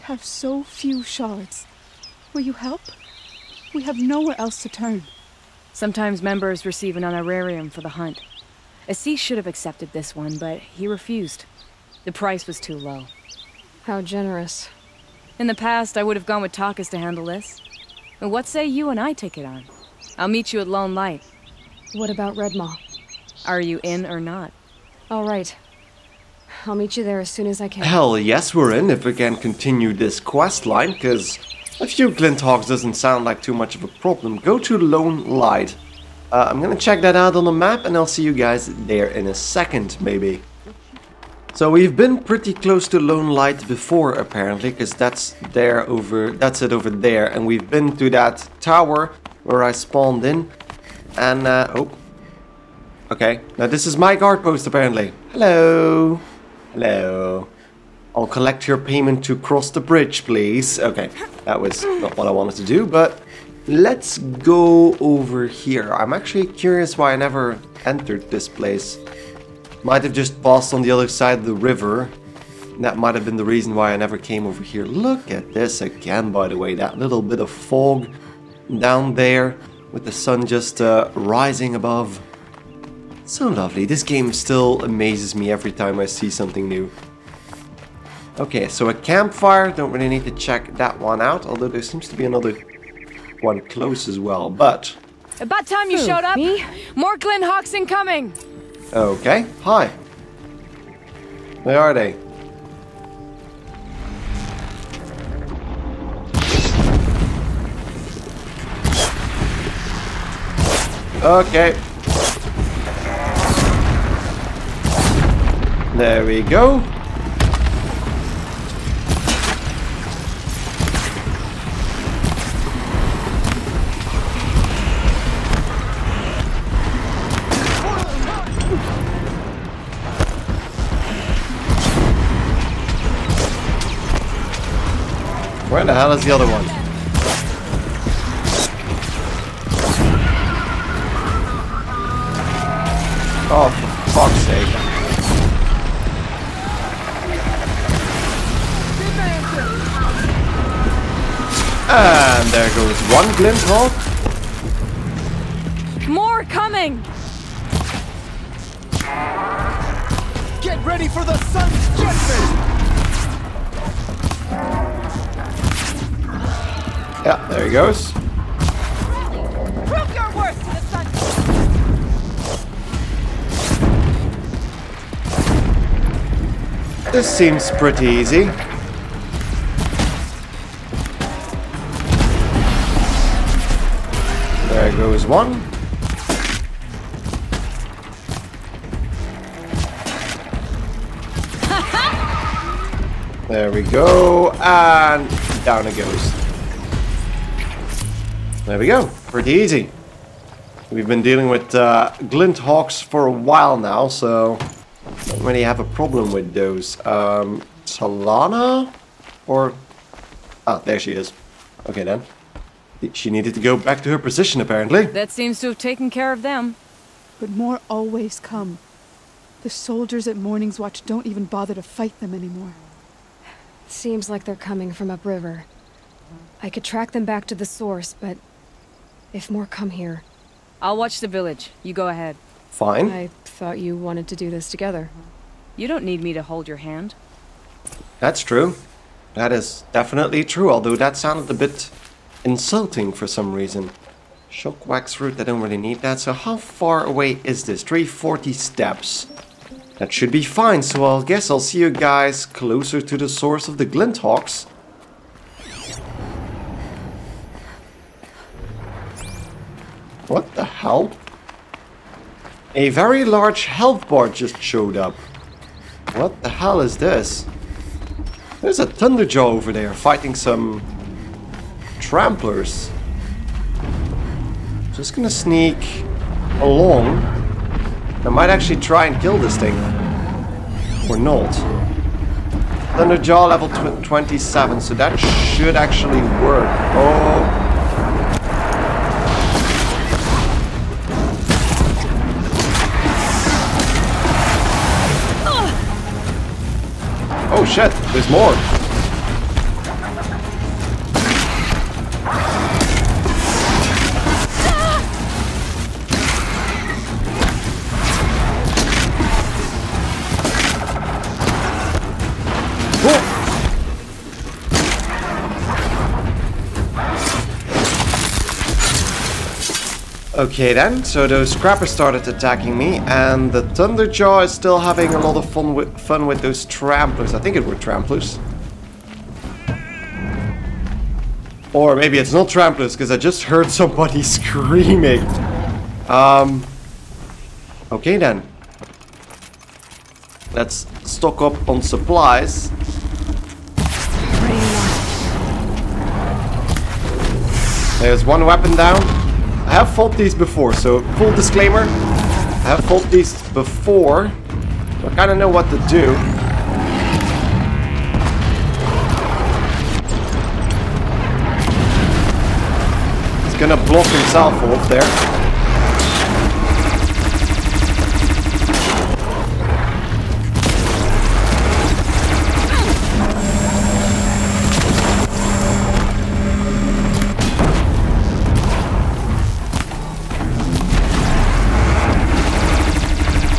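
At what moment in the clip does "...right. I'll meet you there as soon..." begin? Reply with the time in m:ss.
0:25.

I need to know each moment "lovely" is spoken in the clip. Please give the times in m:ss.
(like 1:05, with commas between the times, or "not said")
1:23.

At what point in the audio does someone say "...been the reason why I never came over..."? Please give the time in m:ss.
1:13.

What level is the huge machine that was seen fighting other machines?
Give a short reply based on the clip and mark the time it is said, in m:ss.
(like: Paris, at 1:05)
27, at 4:44.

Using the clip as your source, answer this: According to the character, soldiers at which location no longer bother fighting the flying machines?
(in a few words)
Morning's Watch.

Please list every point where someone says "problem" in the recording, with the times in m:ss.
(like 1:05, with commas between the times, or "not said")
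0:33, 3:25.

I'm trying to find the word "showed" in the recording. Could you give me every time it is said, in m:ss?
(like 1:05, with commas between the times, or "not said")
1:36, 4:24.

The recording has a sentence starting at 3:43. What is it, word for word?
Seems like they're coming from upriver.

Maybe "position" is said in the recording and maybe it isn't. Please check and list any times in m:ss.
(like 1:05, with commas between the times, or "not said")
3:34.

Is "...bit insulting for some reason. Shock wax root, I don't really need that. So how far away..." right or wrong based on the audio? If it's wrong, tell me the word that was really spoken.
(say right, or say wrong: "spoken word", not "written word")
right.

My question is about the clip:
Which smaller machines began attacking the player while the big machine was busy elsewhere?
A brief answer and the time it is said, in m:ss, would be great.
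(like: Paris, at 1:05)
scrappers, at 5:21.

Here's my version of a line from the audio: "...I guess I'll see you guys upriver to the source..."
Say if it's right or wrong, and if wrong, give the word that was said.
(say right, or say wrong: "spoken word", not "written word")
wrong: "closer", not "upriver".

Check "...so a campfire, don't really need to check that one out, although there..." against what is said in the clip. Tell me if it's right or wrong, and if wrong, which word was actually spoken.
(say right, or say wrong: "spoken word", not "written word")
right.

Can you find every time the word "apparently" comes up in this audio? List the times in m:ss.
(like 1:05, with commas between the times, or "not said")
0:44, 0:54, 3:34.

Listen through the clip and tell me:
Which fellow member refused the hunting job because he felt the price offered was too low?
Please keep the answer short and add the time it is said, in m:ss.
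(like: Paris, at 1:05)
Ahsis, at 0:08.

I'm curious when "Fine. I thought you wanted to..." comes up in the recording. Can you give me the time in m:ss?
3:52.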